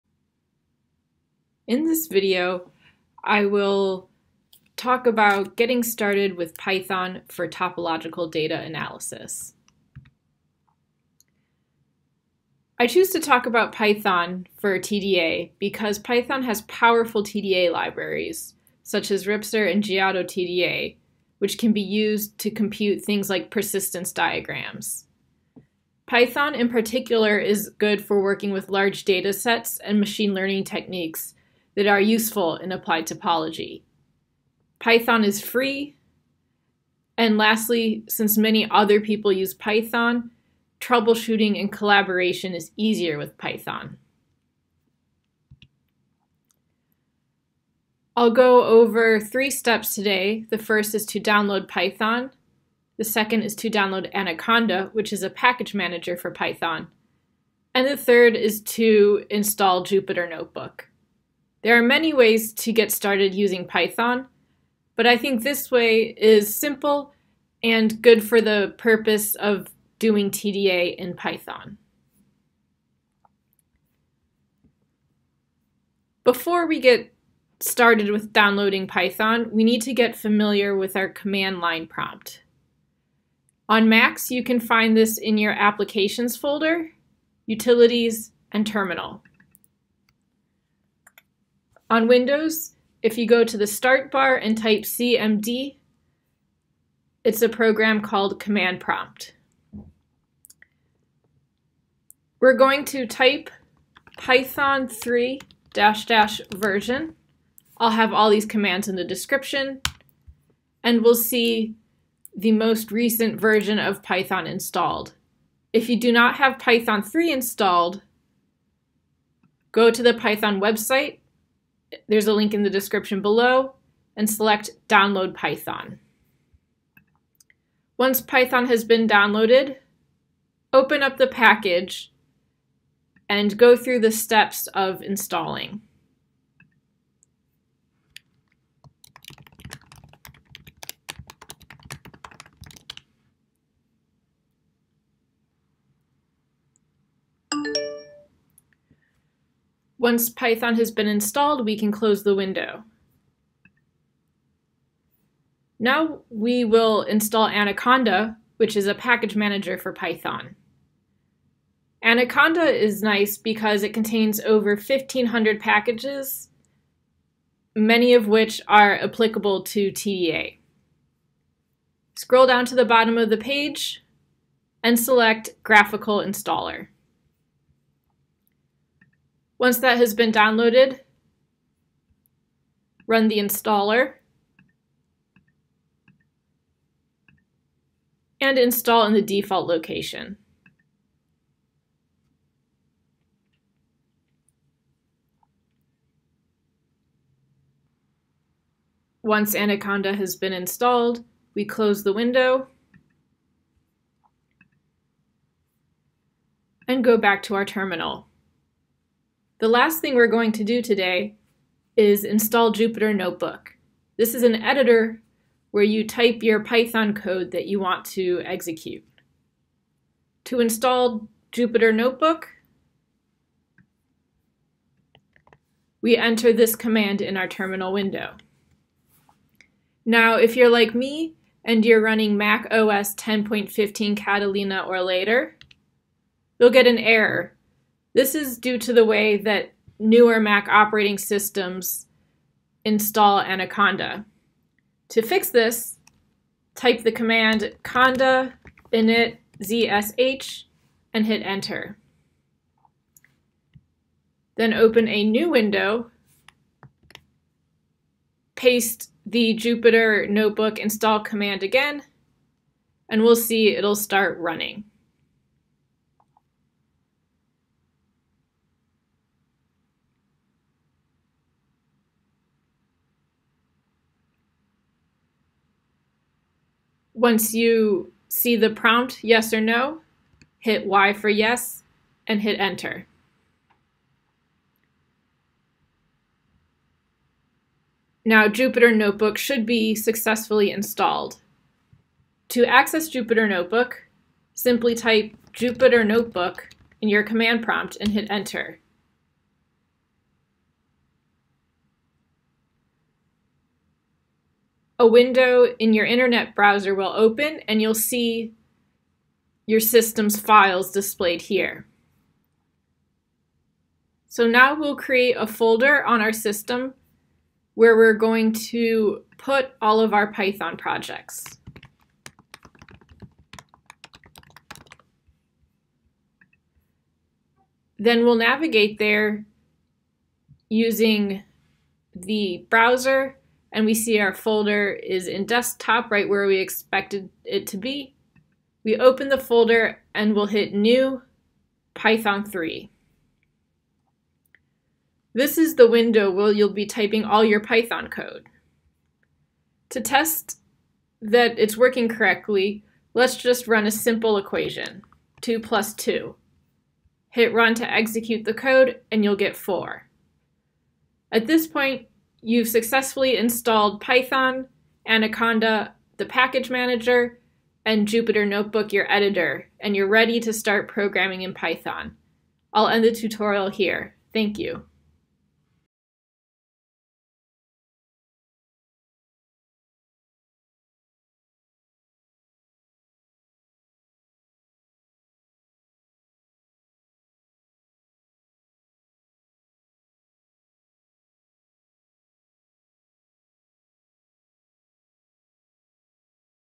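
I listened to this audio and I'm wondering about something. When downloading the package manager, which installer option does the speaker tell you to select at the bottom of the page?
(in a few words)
Graphical Installer.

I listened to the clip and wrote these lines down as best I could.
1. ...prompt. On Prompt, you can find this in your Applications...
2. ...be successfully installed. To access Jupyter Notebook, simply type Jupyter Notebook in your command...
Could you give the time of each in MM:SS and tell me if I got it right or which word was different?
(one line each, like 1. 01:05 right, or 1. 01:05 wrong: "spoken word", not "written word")
1. 01:21 wrong: "Macs", not "Prompt"
2. 04:49 right.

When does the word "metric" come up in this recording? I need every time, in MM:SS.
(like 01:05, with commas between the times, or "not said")
not said.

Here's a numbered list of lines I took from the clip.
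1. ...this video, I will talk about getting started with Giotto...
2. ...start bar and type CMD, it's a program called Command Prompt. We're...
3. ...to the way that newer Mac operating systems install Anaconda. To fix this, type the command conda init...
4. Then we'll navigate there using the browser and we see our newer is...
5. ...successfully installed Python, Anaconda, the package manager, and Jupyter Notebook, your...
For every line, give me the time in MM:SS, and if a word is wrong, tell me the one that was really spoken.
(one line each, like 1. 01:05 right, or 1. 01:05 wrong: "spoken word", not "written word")
1. 00:01 wrong: "Python", not "Giotto"
2. 01:33 right
3. 03:58 right
4. 05:27 wrong: "folder", not "newer"
5. 06:02 right.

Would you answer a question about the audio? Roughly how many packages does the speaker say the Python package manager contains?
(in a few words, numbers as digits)
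1,500.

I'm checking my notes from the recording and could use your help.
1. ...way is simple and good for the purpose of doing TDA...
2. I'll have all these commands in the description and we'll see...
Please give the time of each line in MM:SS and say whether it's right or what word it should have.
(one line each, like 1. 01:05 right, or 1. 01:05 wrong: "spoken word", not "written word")
1. 01:05 right
2. 01:47 right.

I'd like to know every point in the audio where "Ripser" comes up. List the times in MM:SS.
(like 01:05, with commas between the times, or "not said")
00:19.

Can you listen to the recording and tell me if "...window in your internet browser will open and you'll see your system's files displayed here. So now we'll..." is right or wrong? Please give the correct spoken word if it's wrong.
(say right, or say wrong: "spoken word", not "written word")
right.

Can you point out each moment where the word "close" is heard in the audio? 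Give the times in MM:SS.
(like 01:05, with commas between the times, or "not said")
02:31, 03:21.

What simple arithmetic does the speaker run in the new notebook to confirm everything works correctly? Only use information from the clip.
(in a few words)
2 plus 2.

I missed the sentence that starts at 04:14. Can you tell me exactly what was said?
Then open a new window, paste the Jupyter notebook install command again, and we'll see it'll start running.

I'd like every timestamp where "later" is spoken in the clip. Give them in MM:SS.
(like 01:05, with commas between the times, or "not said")
03:55.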